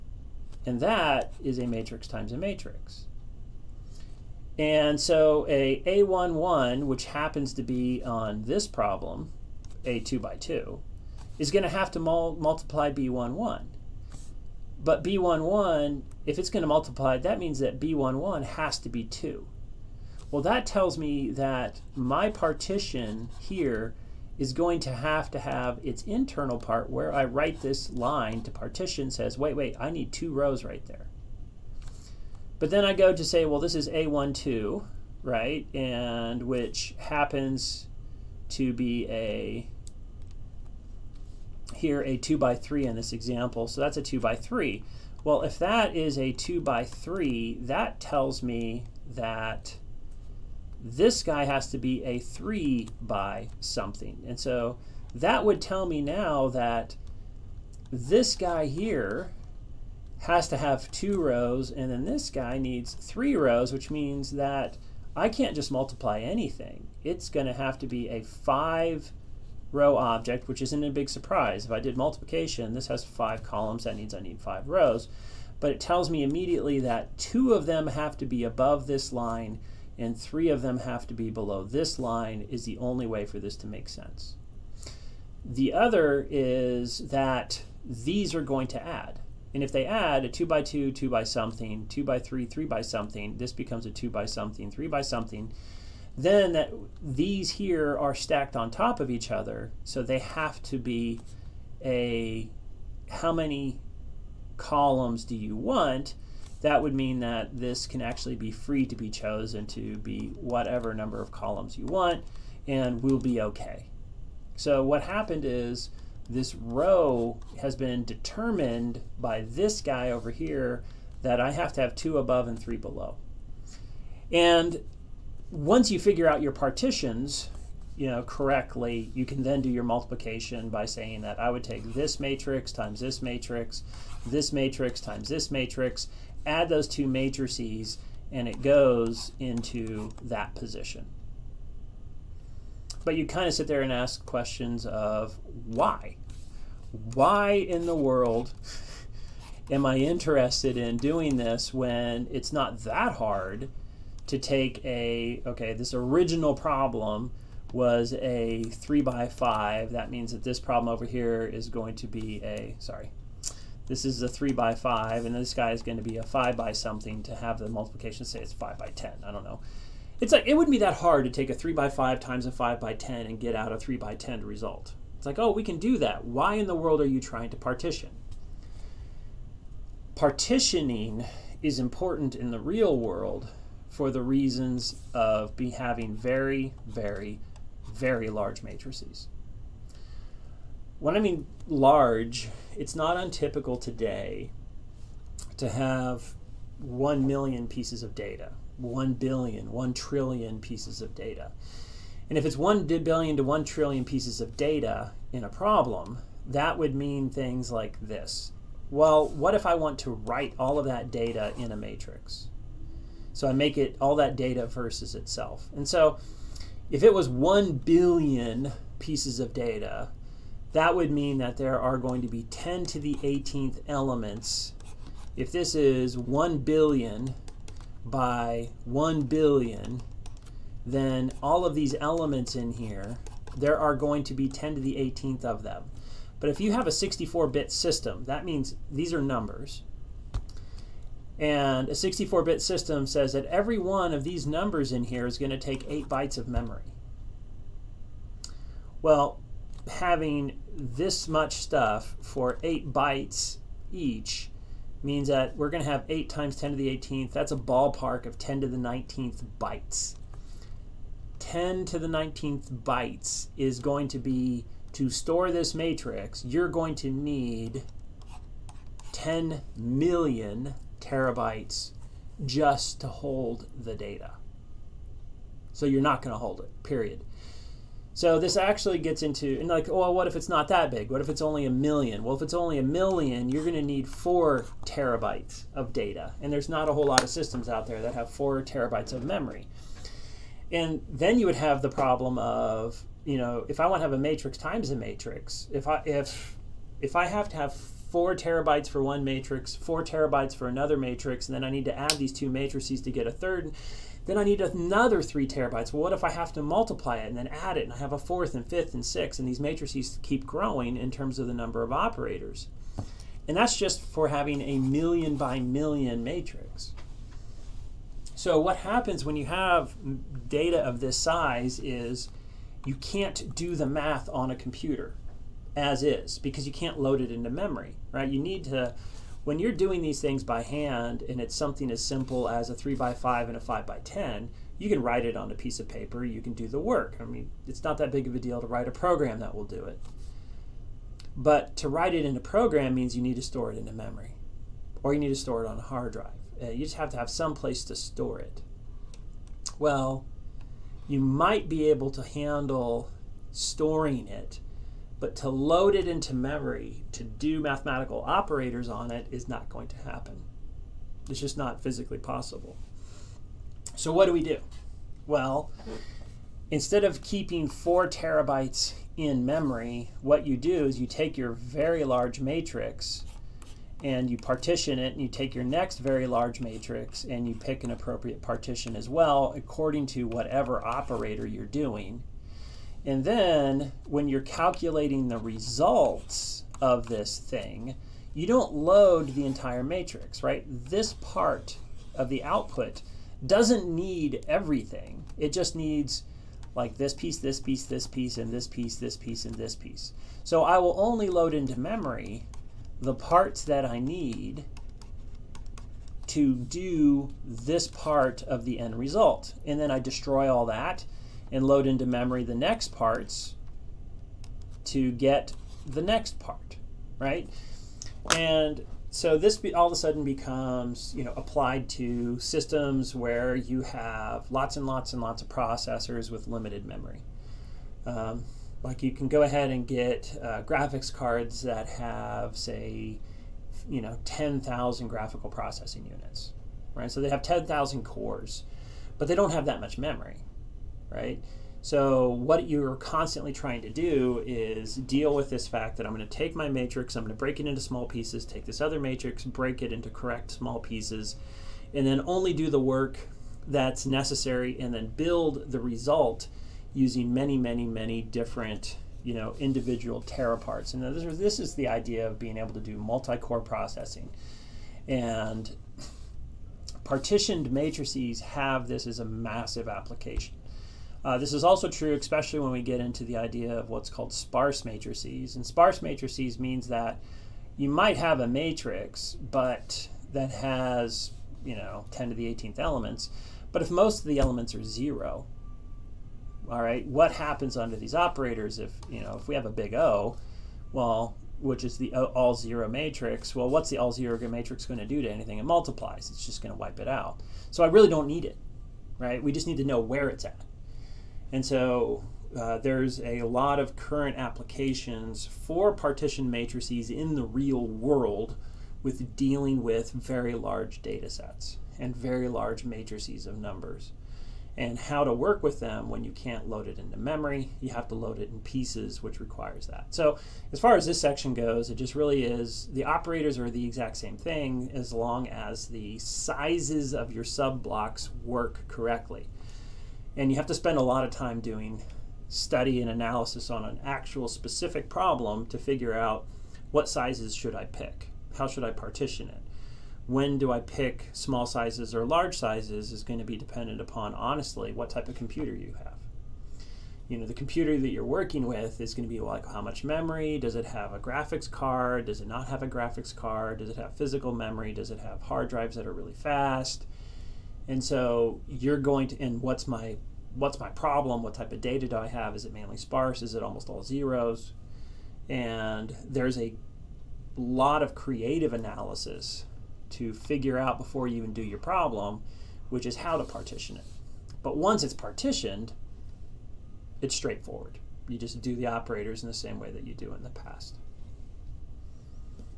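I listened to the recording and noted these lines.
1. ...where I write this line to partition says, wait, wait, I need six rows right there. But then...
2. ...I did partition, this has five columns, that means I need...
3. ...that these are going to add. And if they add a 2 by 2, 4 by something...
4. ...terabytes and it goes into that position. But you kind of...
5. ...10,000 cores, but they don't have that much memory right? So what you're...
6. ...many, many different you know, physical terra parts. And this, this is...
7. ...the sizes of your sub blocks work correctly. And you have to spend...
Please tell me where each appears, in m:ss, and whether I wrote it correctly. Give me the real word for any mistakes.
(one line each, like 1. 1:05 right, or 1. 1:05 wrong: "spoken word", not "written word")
1. 0:26 wrong: "two", not "six"
2. 1:11 wrong: "multiplication", not "partition"
3. 1:27 wrong: "2", not "4"
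4. 2:17 wrong: "matrices", not "terabytes"
5. 7:17 right
6. 7:37 wrong: "individual", not "physical"
7. 8:45 right.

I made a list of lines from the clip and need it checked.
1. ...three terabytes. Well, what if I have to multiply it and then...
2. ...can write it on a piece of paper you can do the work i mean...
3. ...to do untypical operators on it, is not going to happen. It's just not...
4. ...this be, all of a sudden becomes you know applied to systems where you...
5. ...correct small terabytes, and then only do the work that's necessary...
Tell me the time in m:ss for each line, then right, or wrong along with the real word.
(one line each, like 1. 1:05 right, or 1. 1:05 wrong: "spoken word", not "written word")
1. 5:05 right
2. 5:34 right
3. 5:57 wrong: "mathematical", not "untypical"
4. 6:59 right
5. 7:30 wrong: "pieces", not "terabytes".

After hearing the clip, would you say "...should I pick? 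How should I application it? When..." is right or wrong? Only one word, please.
wrong.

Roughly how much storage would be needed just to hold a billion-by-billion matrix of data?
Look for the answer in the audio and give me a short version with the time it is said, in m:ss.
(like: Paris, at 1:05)
10 million terabytes, at 4:29.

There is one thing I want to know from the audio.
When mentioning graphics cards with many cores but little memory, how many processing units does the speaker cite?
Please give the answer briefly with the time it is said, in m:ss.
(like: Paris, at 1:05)
10,000, at 7:14.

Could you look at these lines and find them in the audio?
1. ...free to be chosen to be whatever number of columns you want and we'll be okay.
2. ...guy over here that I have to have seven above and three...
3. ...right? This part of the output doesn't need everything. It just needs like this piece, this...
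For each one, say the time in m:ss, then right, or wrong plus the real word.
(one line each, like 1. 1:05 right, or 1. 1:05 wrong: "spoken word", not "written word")
1. 1:48 right
2. 1:59 wrong: "two", not "seven"
3. 6:30 right.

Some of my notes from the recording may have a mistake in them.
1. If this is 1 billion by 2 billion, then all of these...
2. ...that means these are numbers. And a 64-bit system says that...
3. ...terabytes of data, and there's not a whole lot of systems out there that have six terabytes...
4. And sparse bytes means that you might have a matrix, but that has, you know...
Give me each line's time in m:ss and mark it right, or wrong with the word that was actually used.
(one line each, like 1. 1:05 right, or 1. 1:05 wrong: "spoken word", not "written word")
1. 3:45 wrong: "1", not "2"
2. 3:58 right
3. 4:44 wrong: "four", not "six"
4. 7:55 wrong: "matrices", not "bytes".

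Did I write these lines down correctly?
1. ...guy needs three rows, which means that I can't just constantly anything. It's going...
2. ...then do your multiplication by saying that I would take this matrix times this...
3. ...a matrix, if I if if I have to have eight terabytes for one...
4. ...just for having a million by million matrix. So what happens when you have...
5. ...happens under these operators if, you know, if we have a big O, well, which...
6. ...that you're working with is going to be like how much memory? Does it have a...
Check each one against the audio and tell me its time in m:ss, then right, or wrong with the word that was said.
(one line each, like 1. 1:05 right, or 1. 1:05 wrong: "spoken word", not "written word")
1. 1:02 wrong: "multiply", not "constantly"
2. 2:09 right
3. 4:54 wrong: "four", not "eight"
4. 5:13 right
5. 8:07 right
6. 9:07 right.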